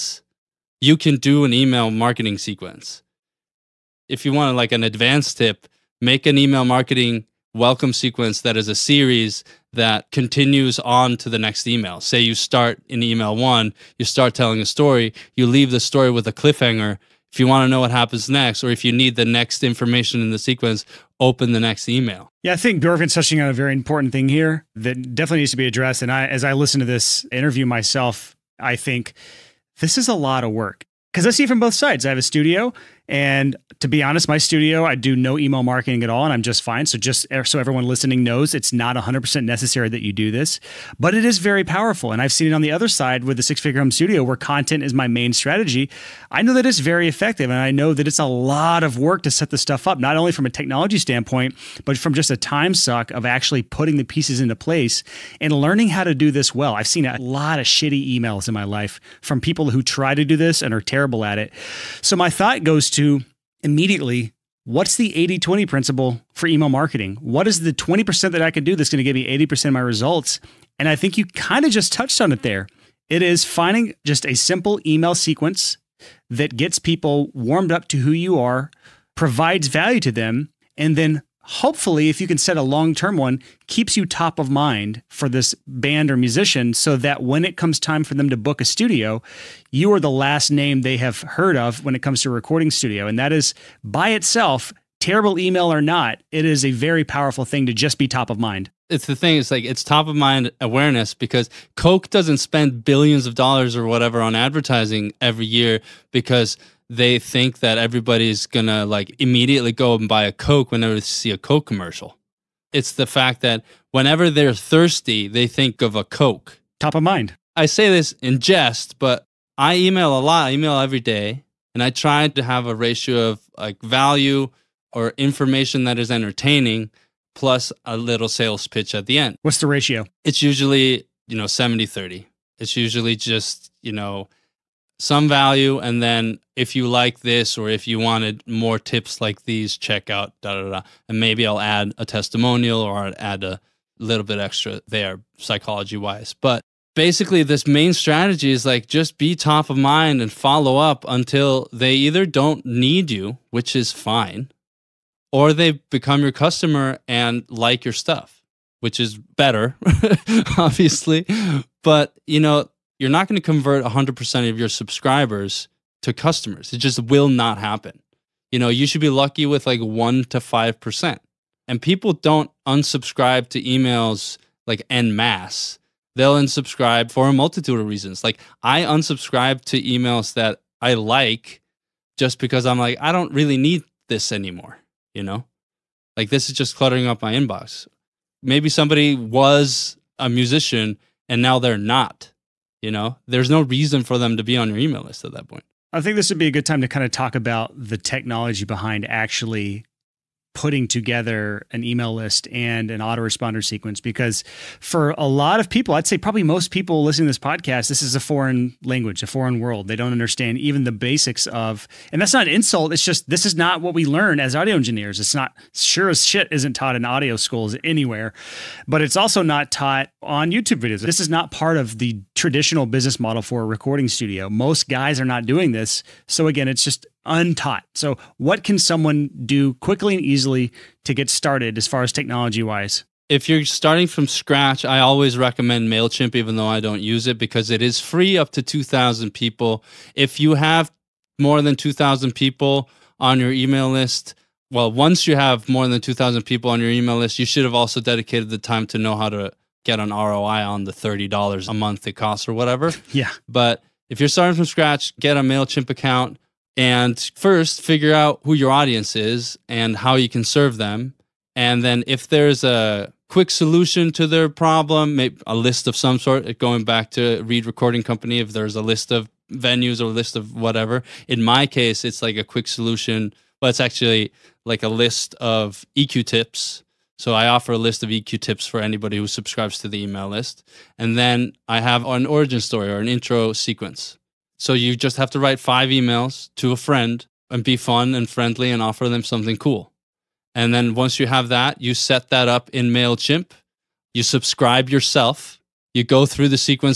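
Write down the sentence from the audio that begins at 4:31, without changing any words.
In my case, it's like a quick solution, but it's actually like a list of EQ tips.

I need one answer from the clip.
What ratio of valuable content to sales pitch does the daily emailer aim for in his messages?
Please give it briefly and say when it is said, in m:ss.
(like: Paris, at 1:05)
70 30, at 2:11.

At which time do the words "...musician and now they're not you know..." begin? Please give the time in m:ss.
3:10.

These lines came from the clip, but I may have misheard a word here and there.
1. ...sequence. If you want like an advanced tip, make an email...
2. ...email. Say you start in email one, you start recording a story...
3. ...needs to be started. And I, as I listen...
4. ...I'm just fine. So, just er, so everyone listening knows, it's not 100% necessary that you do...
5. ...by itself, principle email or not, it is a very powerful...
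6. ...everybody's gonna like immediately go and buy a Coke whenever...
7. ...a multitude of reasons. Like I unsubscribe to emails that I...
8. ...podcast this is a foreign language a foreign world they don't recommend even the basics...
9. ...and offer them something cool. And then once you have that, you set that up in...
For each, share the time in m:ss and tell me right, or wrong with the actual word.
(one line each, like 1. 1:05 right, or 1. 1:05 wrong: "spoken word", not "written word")
1. 0:02 right
2. 0:11 wrong: "telling", not "recording"
3. 0:25 wrong: "addressed", not "started"
4. 0:36 right
5. 1:33 wrong: "terrible", not "principle"
6. 1:47 right
7. 2:57 right
8. 3:27 wrong: "understand", not "recommend"
9. 4:48 right.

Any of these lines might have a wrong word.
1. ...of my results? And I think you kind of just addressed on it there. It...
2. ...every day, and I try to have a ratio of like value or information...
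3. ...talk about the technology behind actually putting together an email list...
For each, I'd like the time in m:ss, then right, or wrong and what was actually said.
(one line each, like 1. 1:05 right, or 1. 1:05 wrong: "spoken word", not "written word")
1. 1:09 wrong: "touched", not "addressed"
2. 2:00 right
3. 3:17 right.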